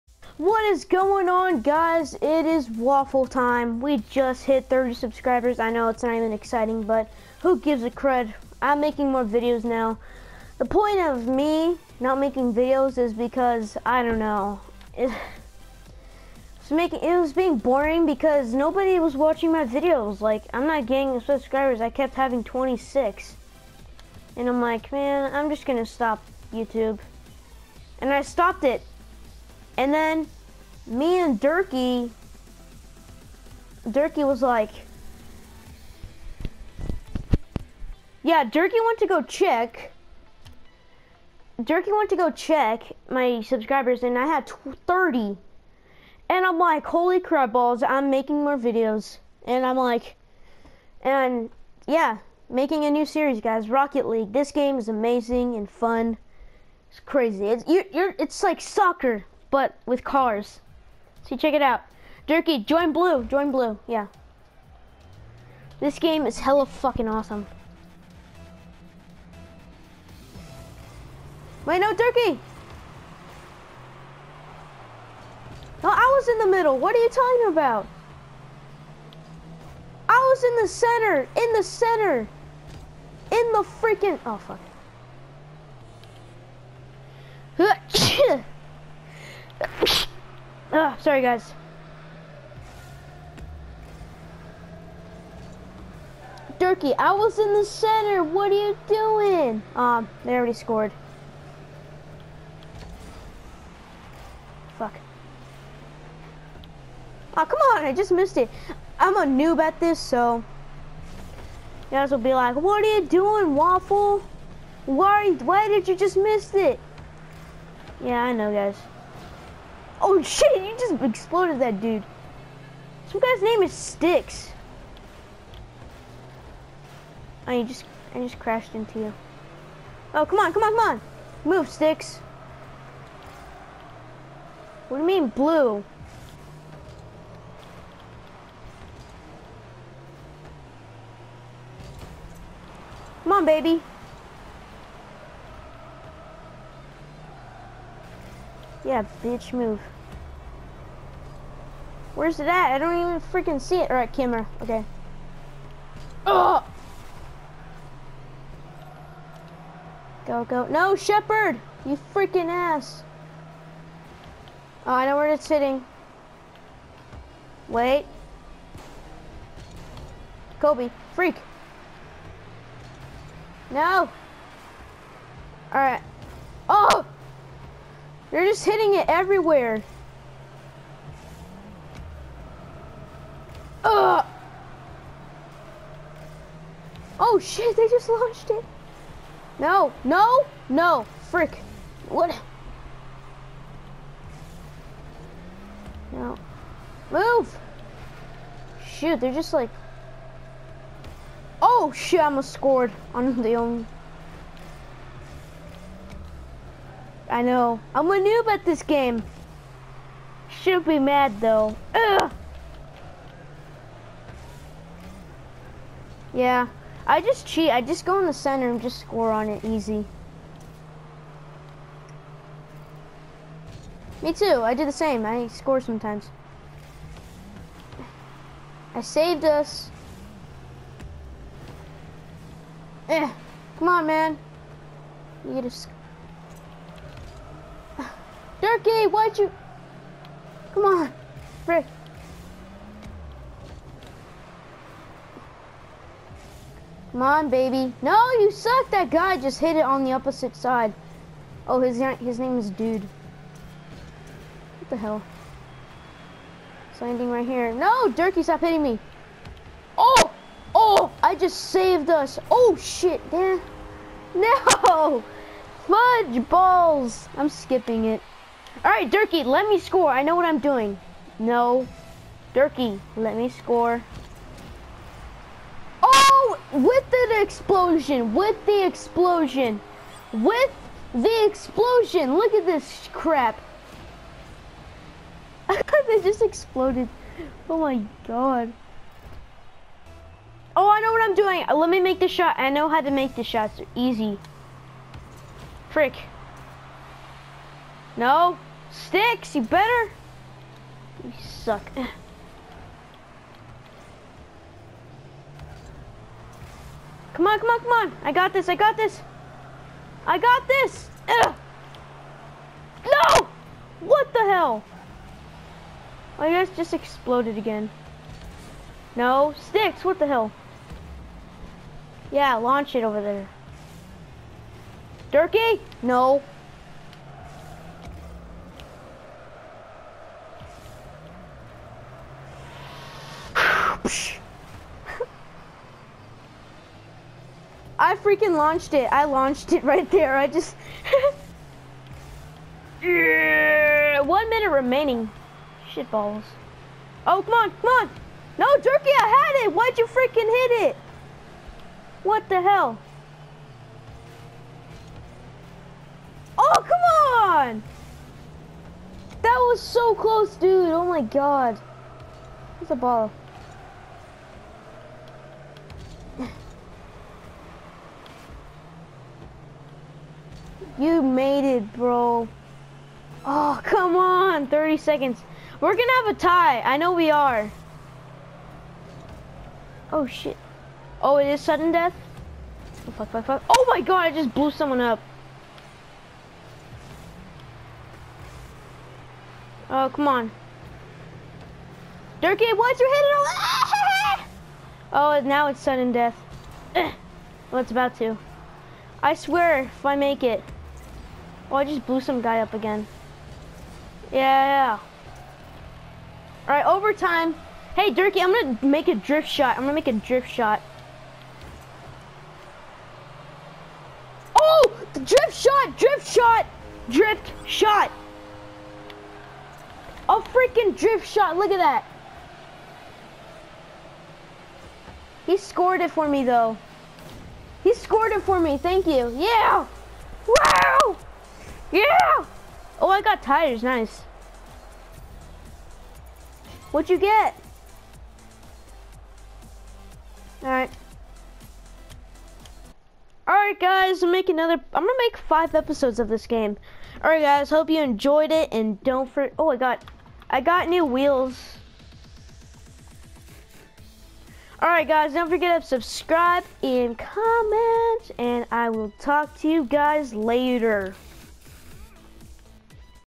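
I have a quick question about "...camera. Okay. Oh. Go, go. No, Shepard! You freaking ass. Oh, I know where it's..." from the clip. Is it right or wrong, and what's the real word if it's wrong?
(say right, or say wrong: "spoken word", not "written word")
right.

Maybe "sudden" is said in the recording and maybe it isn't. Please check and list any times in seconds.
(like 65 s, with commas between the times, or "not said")
381 s, 395 s.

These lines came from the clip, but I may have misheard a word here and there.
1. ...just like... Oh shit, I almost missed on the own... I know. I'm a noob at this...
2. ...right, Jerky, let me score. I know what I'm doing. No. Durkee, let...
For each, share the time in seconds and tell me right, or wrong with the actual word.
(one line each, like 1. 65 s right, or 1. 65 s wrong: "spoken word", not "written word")
1. 199 s wrong: "scored", not "missed"
2. 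268 s wrong: "Durkee", not "Jerky".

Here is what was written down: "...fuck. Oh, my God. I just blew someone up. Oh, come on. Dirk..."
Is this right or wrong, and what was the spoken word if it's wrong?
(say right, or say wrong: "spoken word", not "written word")
right.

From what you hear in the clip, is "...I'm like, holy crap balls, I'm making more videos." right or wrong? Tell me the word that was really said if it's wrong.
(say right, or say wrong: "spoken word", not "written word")
right.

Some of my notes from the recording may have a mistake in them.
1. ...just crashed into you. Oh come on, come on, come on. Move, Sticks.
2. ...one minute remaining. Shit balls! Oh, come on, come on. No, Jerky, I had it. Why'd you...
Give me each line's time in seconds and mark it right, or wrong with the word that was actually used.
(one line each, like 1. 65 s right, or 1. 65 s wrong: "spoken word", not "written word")
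1. 128 s right
2. 344 s right.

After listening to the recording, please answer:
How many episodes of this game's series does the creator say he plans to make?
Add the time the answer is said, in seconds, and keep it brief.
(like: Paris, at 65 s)
5, at 445 s.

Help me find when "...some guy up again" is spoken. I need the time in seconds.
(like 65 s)
402 s.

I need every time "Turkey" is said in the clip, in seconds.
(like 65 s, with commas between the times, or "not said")
71 s, 238 s, 325 s.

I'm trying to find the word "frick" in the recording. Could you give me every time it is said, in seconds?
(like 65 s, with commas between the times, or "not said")
191 s, 295 s.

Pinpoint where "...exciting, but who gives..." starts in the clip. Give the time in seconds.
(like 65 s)
6 s.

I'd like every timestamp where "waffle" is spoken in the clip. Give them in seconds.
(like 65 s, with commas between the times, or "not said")
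2 s, 113 s.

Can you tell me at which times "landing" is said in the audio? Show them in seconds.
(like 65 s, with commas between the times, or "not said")
257 s.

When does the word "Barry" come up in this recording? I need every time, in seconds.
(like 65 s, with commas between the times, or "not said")
not said.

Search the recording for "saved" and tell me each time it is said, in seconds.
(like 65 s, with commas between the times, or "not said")
228 s, 261 s.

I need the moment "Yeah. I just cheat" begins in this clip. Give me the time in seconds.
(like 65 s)
216 s.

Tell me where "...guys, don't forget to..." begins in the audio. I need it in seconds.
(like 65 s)
455 s.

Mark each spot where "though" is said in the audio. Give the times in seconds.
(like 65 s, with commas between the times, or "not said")
211 s, 426 s.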